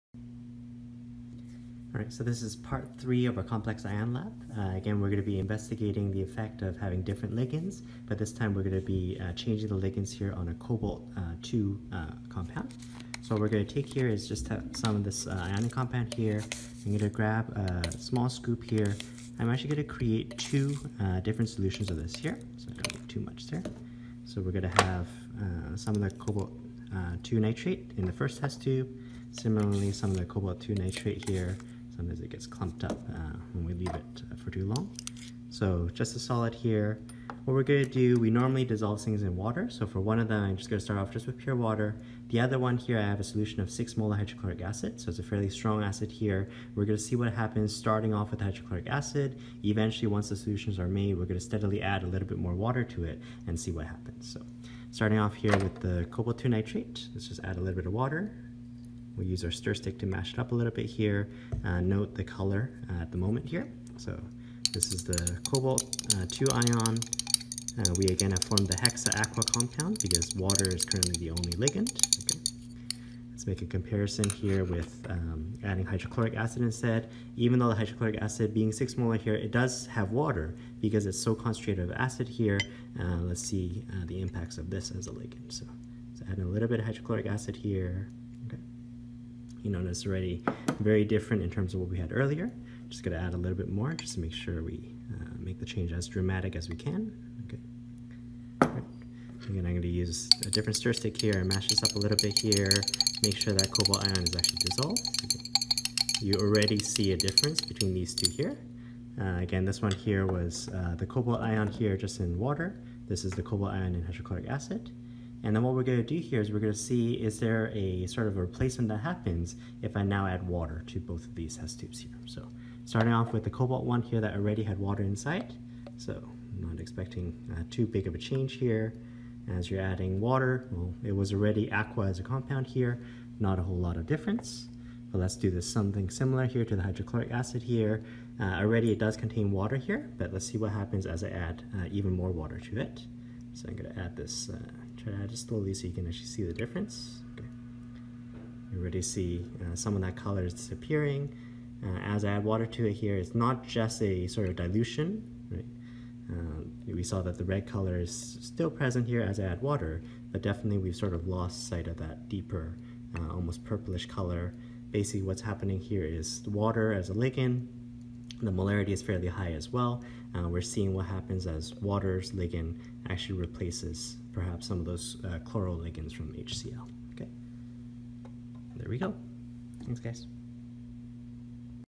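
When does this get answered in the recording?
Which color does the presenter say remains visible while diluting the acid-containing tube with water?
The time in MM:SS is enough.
02:37.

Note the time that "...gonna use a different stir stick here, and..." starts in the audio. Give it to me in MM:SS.
01:39.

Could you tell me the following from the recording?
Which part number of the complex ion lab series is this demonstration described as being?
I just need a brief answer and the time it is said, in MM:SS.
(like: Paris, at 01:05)
Part three, at 00:02.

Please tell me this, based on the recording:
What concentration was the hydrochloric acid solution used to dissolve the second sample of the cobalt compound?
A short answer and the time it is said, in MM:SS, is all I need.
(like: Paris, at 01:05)
6 molar, at 00:43.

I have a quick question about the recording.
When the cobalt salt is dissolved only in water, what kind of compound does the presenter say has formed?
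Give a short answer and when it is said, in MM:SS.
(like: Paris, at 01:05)
Hexa aqua compound, at 01:08.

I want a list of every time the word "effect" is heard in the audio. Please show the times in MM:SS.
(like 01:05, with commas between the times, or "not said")
00:06.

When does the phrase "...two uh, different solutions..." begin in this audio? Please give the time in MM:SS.
00:20.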